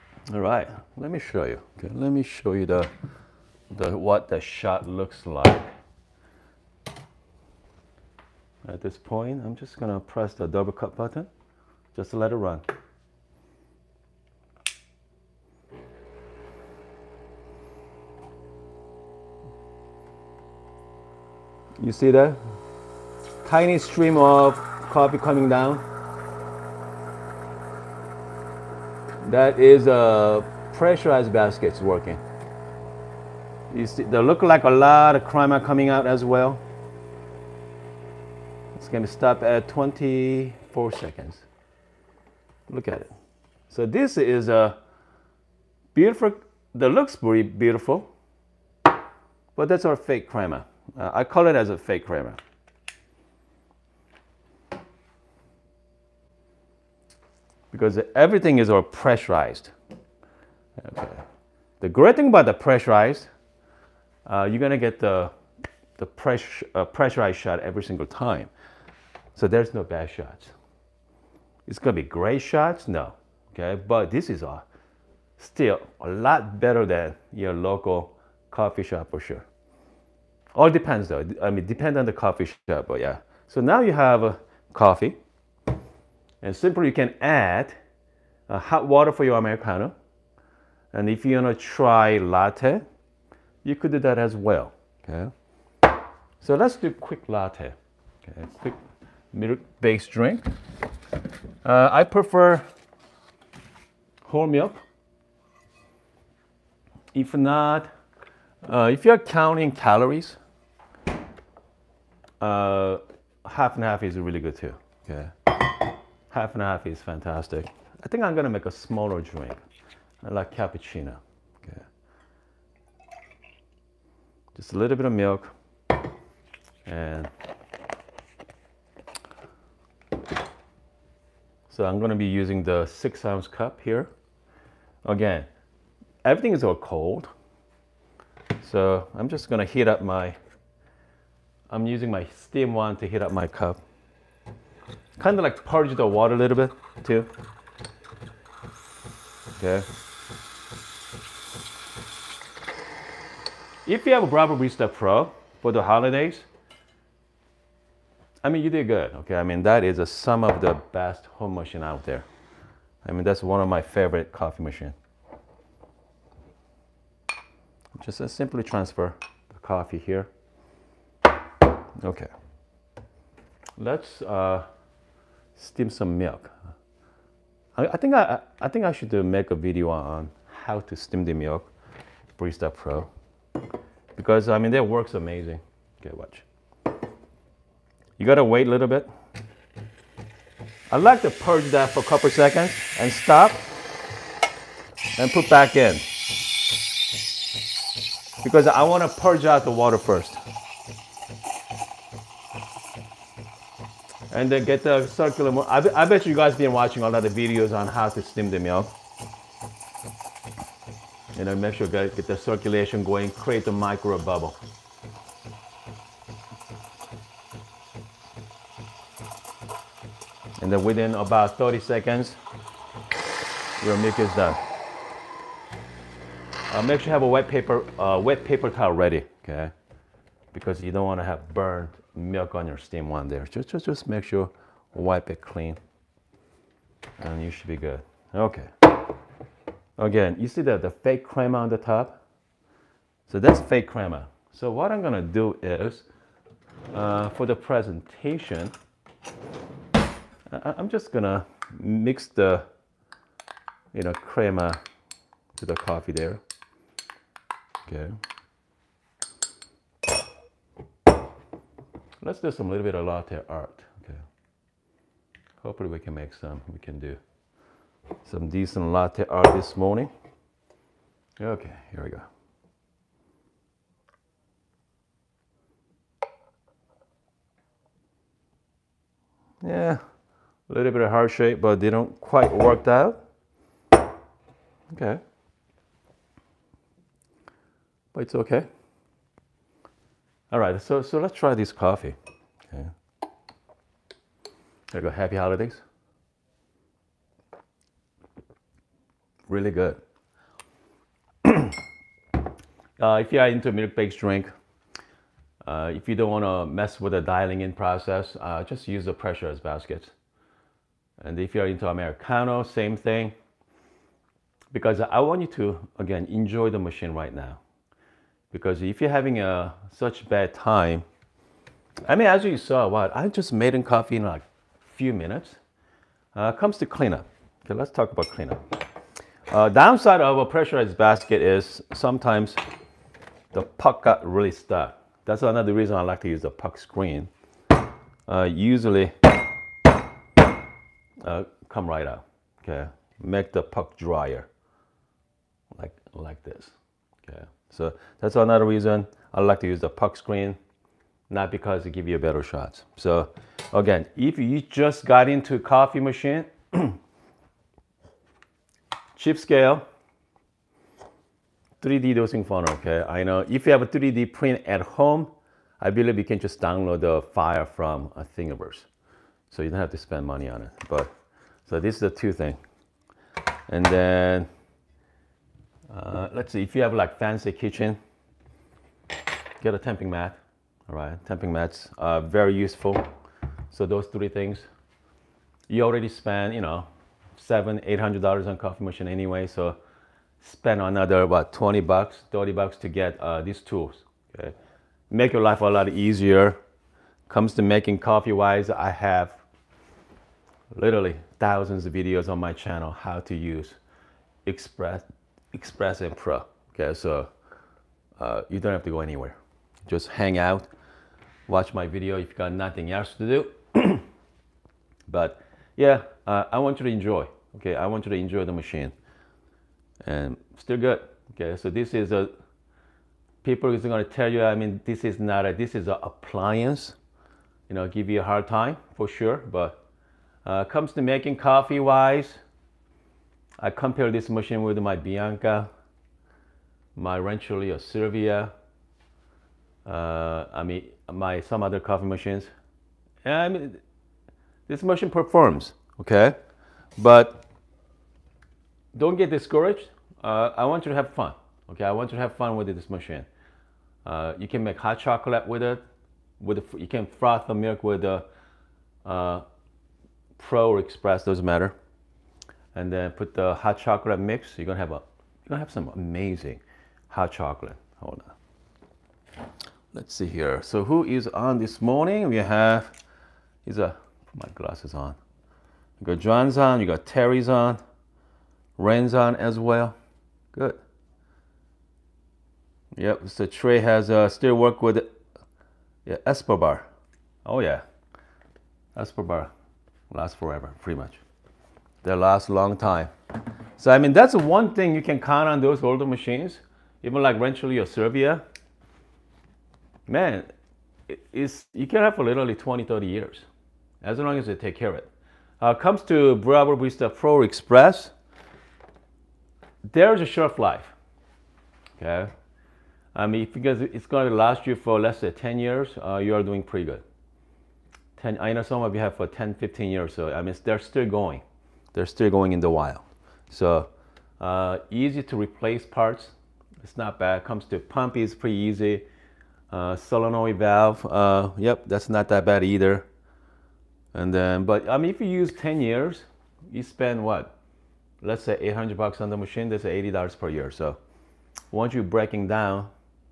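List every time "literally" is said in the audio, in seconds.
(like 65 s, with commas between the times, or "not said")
400 s, 502 s.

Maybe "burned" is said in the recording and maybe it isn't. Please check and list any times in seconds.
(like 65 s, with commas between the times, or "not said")
231 s.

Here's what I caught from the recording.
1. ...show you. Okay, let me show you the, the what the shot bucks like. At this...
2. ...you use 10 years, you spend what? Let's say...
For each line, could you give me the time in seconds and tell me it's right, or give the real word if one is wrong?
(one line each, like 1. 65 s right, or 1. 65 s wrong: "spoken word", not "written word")
1. 1 s wrong: "looks", not "bucks"
2. 535 s right.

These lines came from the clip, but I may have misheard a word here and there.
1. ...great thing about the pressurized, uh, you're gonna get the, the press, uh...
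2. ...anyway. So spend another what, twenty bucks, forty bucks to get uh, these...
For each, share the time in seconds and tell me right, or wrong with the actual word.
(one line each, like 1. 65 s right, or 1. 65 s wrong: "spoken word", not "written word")
1. 61 s right
2. 389 s wrong: "thirty", not "forty".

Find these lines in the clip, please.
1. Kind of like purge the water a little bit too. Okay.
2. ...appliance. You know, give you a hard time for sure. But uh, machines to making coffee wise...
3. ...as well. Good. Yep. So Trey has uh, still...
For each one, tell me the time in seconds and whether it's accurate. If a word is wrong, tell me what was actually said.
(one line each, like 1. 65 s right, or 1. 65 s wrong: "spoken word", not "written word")
1. 145 s right
2. 426 s wrong: "comes", not "machines"
3. 479 s right.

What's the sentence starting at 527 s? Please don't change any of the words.
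Comes to pump is pretty easy.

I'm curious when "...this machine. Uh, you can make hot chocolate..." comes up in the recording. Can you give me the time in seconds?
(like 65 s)
452 s.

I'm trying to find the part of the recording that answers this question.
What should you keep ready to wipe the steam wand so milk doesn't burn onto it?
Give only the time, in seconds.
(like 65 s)
228 s.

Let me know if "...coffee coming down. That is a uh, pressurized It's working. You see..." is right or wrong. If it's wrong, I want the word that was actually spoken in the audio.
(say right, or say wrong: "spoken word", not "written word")
right.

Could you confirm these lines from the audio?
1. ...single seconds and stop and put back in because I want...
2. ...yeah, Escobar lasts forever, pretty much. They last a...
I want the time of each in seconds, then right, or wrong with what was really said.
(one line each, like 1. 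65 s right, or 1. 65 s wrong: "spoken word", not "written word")
1. 192 s wrong: "couple", not "single"
2. 487 s right.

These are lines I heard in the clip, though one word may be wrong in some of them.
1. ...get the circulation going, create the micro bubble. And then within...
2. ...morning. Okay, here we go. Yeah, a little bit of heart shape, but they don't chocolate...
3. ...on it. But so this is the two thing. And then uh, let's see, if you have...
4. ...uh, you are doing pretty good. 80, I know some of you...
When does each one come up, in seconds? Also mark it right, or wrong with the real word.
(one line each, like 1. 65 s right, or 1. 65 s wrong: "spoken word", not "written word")
1. 212 s right
2. 269 s wrong: "quite", not "chocolate"
3. 370 s right
4. 516 s wrong: "10", not "80".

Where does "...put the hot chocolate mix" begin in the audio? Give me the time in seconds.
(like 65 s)
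463 s.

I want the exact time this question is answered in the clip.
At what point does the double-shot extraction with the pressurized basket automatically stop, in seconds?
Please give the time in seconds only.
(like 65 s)
39 s.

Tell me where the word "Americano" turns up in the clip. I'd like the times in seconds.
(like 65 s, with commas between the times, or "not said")
89 s, 311 s.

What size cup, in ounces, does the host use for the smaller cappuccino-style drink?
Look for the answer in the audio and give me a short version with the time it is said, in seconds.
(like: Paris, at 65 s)
6 ounce, at 132 s.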